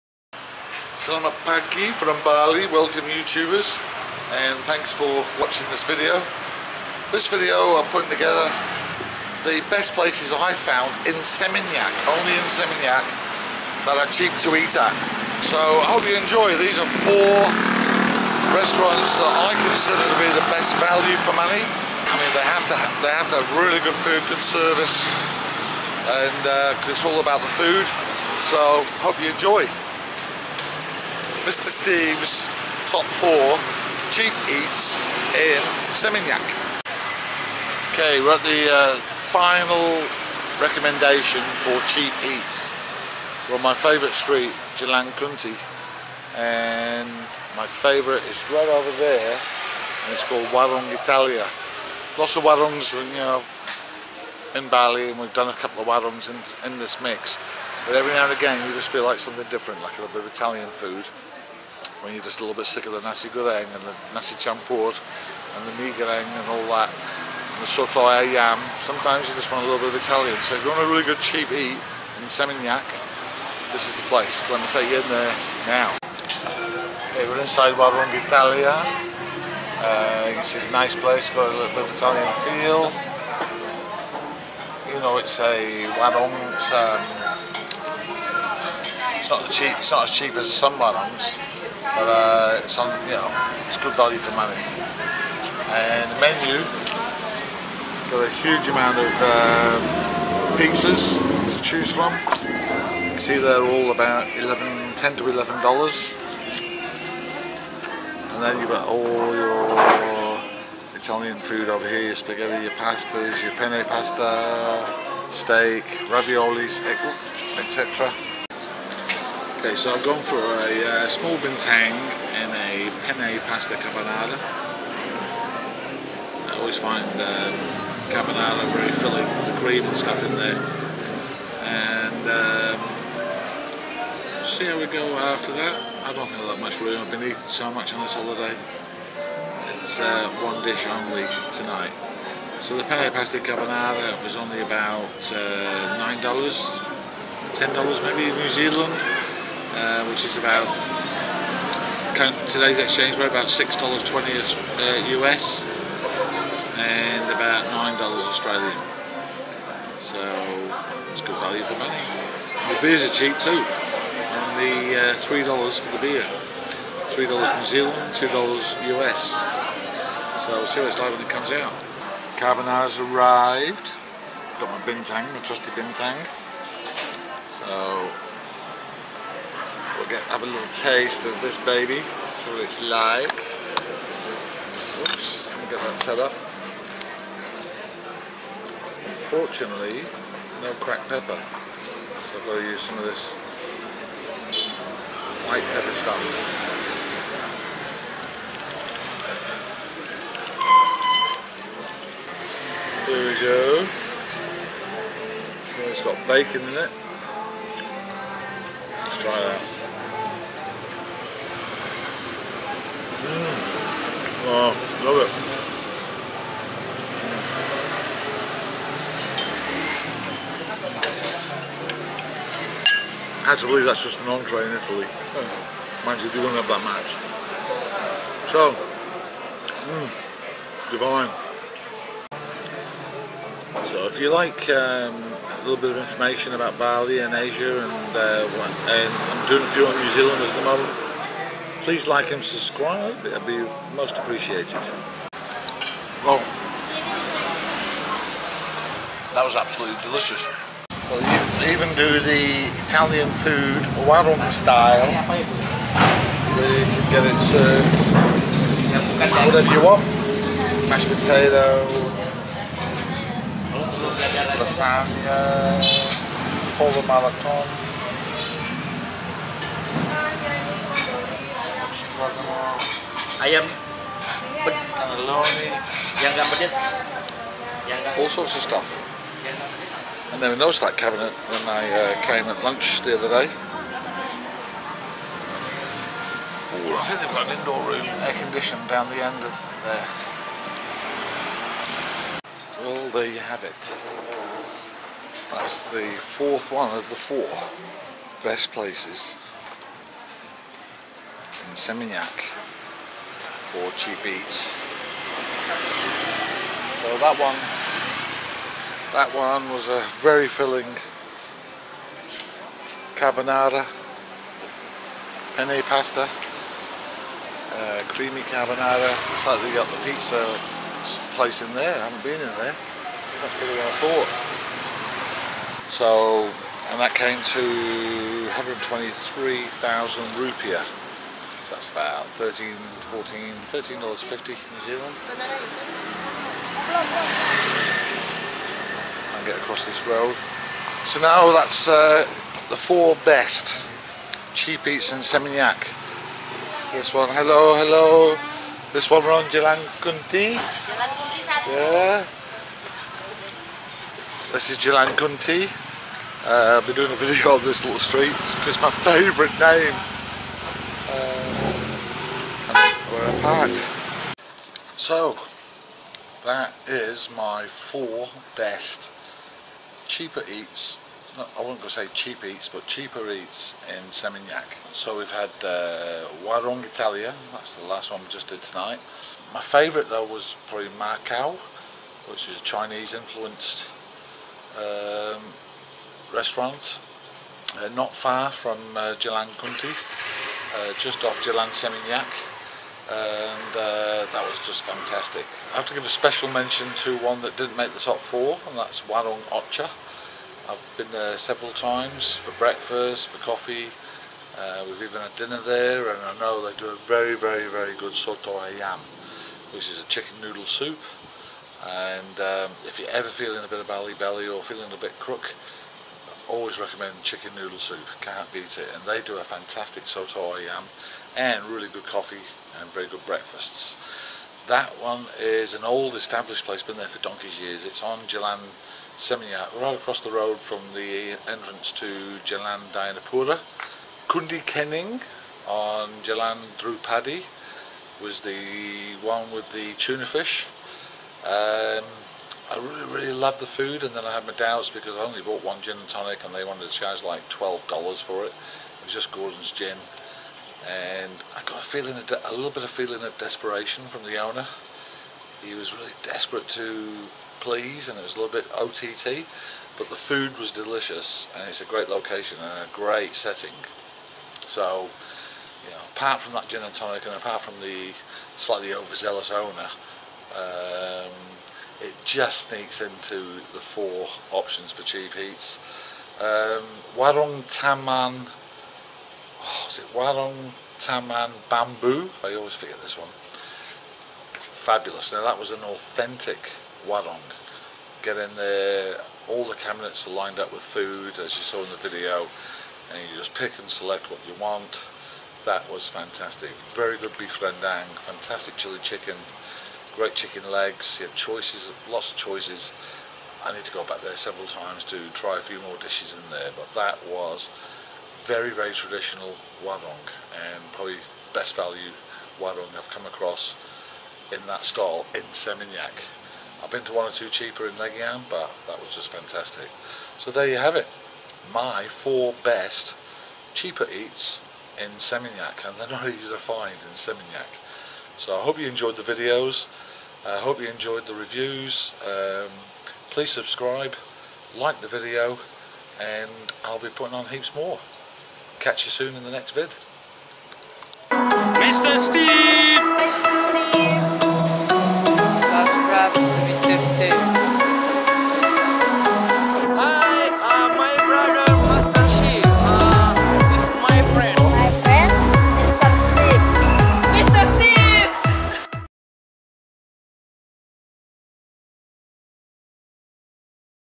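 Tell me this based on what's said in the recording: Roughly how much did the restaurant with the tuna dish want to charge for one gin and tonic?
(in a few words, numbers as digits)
$12.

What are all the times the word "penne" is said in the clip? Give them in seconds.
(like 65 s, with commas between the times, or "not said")
113 s, 123 s, 142 s, 315 s.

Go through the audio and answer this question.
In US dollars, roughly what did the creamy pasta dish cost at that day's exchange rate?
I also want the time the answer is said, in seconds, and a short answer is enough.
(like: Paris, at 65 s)
$6.20, at 153 s.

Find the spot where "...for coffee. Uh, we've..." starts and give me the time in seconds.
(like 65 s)
403 s.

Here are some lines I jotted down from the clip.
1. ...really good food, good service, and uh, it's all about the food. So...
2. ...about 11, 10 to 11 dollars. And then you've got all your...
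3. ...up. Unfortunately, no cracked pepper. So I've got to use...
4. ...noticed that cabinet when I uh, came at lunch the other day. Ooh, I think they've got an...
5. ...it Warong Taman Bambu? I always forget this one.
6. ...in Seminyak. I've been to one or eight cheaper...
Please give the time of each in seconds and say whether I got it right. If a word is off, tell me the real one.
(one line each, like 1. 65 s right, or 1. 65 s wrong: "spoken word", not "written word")
1. 23 s right
2. 103 s right
3. 186 s right
4. 280 s right
5. 480 s right
6. 515 s wrong: "two", not "eight".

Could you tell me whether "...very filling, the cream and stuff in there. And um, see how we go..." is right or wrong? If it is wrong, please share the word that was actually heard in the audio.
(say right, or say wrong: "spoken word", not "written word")
right.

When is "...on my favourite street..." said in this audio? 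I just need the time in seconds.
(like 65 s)
43 s.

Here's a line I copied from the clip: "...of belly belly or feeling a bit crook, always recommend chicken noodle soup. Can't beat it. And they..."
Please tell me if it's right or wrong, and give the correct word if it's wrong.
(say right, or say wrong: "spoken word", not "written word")
right.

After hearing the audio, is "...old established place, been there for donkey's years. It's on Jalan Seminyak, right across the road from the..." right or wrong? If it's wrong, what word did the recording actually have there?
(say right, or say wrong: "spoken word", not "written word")
right.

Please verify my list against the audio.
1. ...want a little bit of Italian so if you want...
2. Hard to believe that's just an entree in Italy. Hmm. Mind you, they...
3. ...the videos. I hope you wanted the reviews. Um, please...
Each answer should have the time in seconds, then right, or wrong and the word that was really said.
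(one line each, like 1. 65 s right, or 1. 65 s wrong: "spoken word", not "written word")
1. 69 s right
2. 223 s right
3. 529 s wrong: "enjoyed", not "wanted".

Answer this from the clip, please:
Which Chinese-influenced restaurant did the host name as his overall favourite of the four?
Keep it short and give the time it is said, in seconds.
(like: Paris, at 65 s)
Macau, at 381 s.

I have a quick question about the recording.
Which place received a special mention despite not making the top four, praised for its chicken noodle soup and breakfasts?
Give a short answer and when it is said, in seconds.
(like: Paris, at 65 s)
Warung Ocha, at 399 s.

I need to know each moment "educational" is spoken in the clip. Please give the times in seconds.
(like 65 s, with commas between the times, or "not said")
not said.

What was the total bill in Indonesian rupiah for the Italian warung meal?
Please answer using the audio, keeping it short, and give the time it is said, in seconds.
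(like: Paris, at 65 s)
123,000 rupiah, at 328 s.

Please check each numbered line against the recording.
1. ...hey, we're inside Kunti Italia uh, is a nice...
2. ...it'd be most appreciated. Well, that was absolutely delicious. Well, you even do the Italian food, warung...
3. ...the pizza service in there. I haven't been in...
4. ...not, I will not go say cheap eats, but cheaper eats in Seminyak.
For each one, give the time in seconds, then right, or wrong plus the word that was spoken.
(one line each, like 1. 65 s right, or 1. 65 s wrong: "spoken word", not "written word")
1. 77 s wrong: "Warung", not "Kunti"
2. 243 s right
3. 319 s wrong: "place", not "service"
4. 371 s right.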